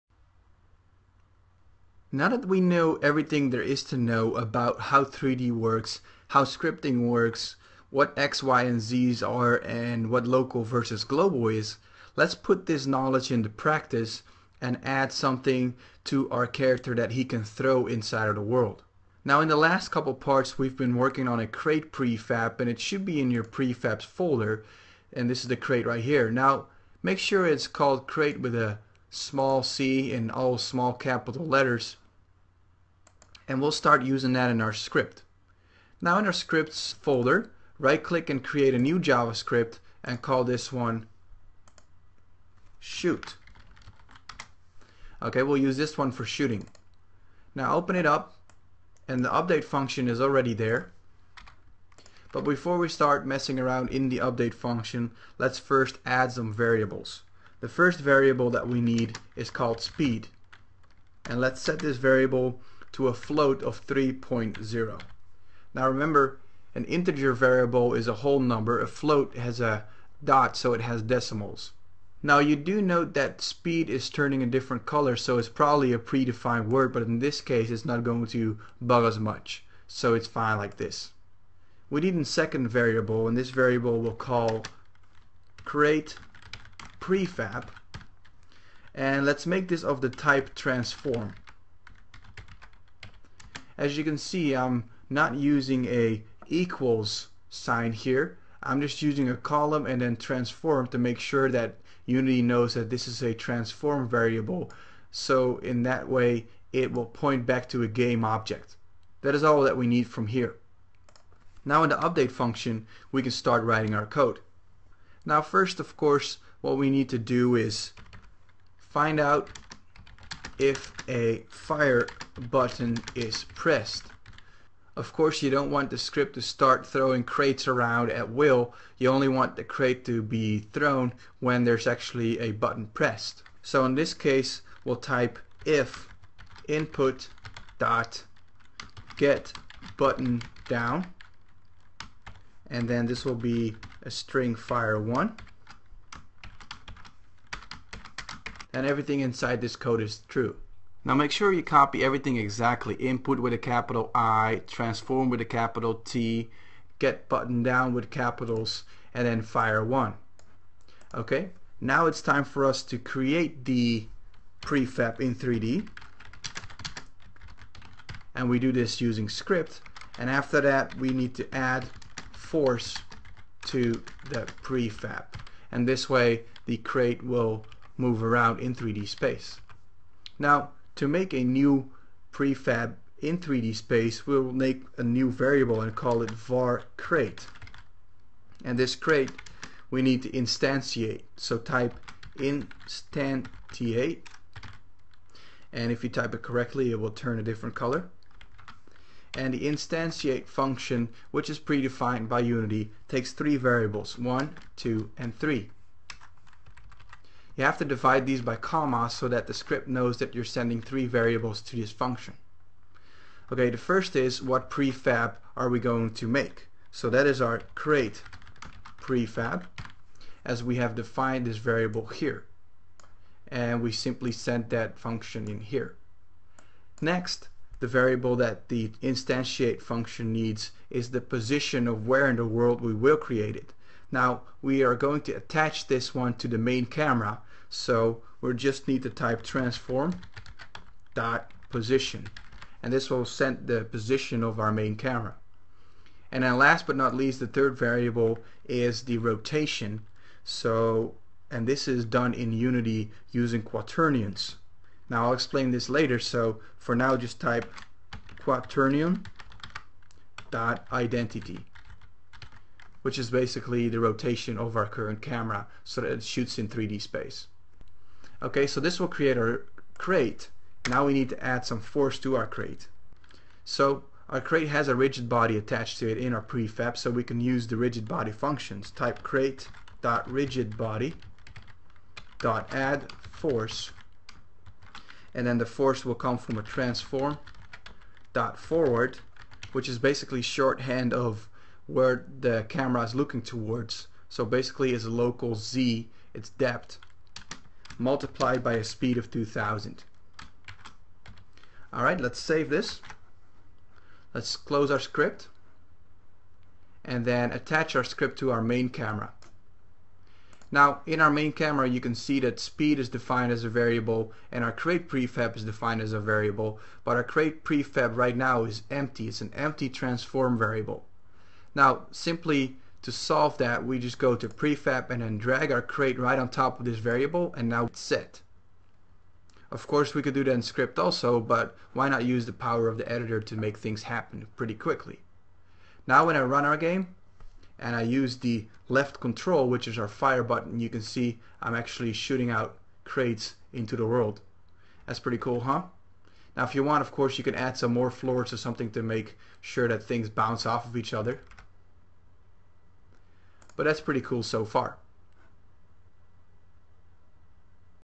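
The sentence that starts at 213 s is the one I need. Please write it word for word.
Okay, the first is what prefab are we going to make?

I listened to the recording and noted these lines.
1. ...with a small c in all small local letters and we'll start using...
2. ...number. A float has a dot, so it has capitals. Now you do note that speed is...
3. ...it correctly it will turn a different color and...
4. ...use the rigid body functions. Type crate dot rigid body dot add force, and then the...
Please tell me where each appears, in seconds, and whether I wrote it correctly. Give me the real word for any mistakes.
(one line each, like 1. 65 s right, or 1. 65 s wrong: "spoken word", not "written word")
1. 28 s wrong: "capital", not "local"
2. 68 s wrong: "decimals", not "capitals"
3. 196 s right
4. 277 s right.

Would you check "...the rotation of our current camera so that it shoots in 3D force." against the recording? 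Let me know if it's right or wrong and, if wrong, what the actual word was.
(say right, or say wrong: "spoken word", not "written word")
wrong: "space", not "force".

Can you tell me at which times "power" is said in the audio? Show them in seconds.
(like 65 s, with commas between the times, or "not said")
332 s.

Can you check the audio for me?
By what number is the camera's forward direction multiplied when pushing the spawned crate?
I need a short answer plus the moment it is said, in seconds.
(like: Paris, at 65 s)
2000, at 299 s.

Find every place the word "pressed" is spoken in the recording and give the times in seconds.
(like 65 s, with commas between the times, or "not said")
123 s, 132 s.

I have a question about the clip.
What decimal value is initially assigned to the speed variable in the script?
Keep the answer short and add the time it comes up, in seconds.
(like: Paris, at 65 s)
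3.0, at 63 s.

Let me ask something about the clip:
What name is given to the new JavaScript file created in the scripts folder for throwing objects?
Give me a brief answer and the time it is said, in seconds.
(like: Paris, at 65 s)
shoot, at 40 s.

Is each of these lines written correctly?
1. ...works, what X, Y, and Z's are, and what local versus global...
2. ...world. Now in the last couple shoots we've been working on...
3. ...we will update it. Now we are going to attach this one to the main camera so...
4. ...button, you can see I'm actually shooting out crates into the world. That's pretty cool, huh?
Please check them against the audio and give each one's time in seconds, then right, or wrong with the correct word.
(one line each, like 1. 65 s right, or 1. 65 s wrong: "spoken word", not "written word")
1. 7 s right
2. 18 s wrong: "parts", not "shoots"
3. 232 s wrong: "create", not "update"
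4. 340 s right.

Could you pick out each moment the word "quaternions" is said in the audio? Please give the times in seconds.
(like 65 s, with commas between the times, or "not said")
253 s, 258 s.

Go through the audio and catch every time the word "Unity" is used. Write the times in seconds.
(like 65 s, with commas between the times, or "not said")
102 s, 202 s, 252 s.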